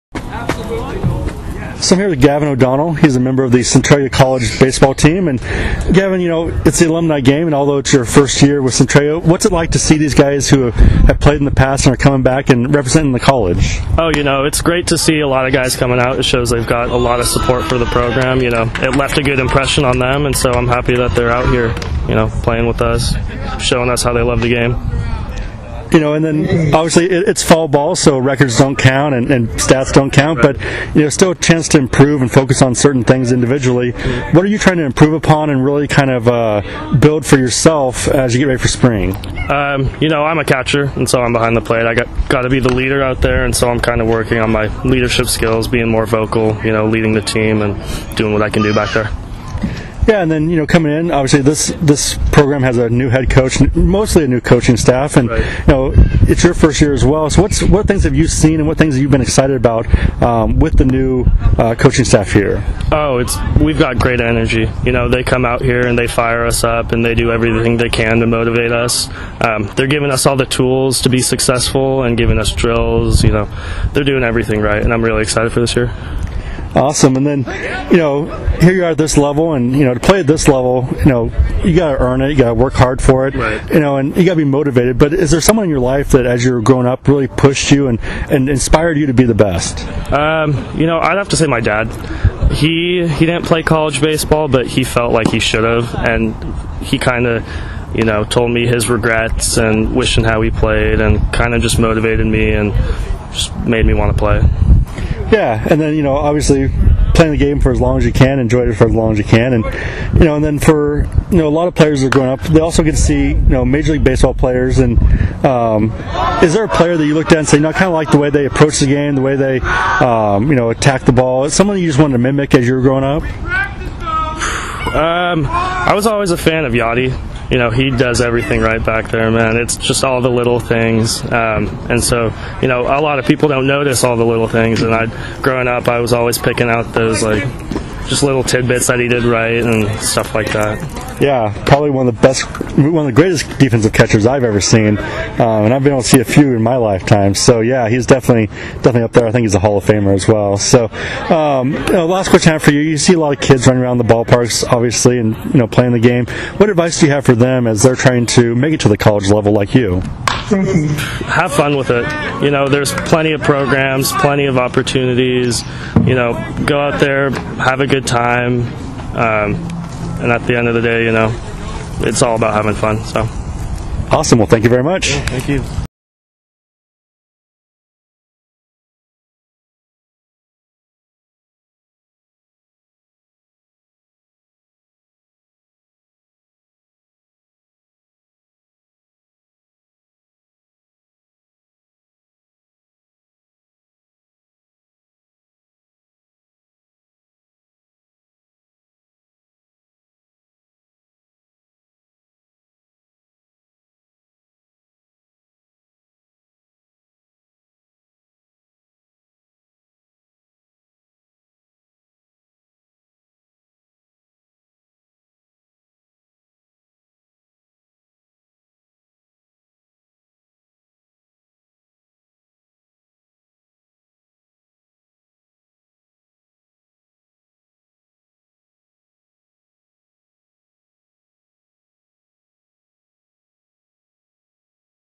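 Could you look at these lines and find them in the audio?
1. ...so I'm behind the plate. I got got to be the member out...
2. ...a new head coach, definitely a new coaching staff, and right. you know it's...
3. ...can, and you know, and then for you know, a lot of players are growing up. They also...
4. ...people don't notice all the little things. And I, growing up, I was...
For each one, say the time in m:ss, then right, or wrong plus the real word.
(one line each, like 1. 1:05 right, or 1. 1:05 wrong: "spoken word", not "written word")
1. 0:41 wrong: "leader", not "member"
2. 0:52 wrong: "mostly", not "definitely"
3. 1:49 right
4. 2:13 right.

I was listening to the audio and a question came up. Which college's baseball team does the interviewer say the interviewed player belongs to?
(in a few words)
Centralia College.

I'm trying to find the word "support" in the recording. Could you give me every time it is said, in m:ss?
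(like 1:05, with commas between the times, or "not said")
0:17.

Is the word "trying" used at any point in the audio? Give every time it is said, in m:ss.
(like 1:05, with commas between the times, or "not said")
0:34, 2:37.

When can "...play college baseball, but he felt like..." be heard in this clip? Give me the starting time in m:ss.
1:33.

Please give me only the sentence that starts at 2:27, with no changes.
So yeah, he's definitely definitely up there.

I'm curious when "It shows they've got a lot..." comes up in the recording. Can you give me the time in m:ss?
0:16.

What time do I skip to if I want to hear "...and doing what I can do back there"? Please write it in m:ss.
0:47.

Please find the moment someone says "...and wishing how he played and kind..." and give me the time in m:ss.
1:39.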